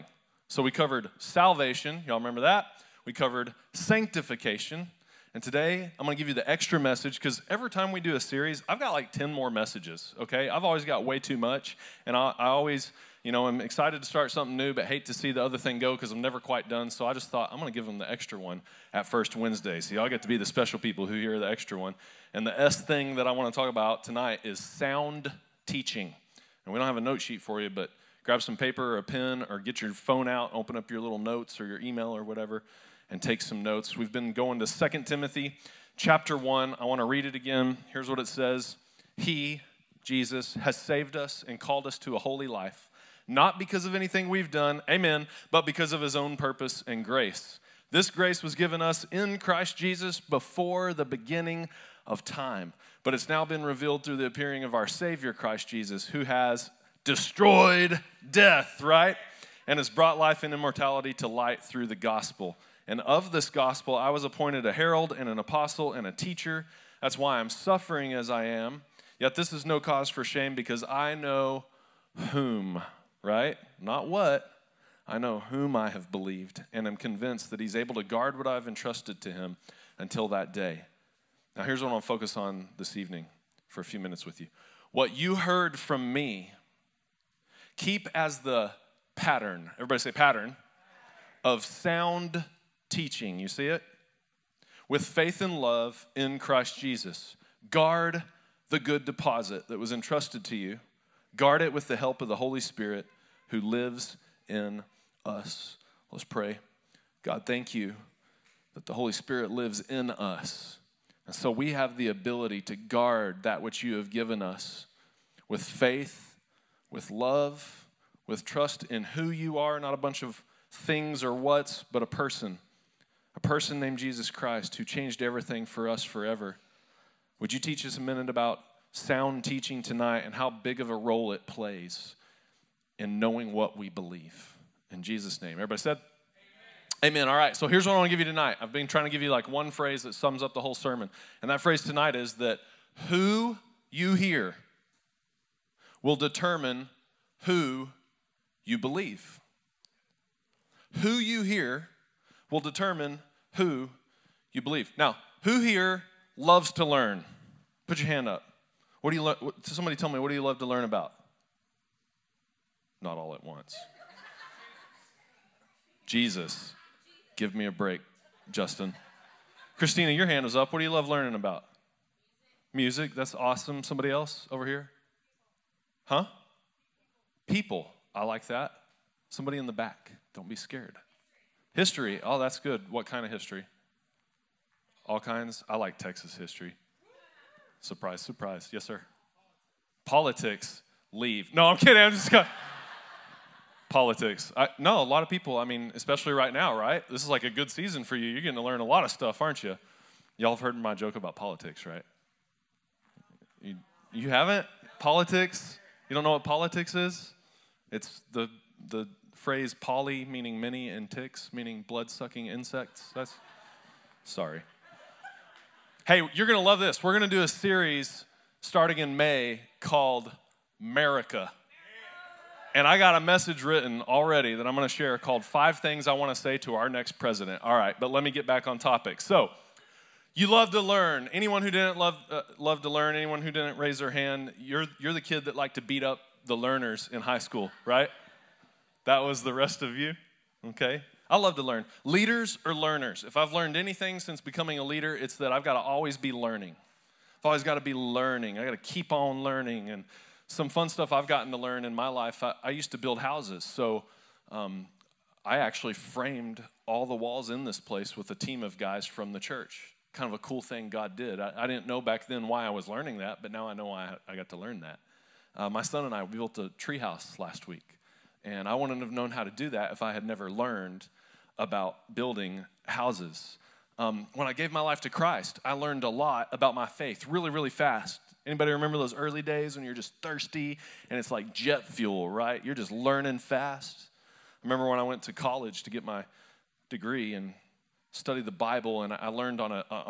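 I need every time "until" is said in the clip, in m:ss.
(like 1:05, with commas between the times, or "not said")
1:19.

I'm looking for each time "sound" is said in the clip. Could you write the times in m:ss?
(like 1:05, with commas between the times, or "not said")
0:24, 1:31, 2:08.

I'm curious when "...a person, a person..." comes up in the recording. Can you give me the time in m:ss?
2:02.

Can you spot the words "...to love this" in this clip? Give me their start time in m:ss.
3:36.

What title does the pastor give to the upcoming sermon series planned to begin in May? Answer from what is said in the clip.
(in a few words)
America.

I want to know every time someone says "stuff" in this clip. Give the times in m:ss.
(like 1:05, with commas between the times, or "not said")
3:19, 4:10.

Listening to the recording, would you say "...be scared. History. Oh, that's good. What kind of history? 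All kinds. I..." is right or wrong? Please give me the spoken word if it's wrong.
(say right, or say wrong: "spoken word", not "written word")
right.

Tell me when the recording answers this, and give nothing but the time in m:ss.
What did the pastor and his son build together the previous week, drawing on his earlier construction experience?
4:26.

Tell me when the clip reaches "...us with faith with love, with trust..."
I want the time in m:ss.
1:54.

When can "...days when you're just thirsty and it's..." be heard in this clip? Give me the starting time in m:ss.
4:39.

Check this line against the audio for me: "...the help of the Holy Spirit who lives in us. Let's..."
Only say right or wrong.
right.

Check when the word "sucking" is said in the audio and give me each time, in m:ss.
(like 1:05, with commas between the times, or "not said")
3:32.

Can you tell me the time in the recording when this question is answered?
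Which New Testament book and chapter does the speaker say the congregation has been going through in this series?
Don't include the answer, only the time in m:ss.
0:34.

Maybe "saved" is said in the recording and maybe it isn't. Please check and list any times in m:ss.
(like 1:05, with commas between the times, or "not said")
0:40.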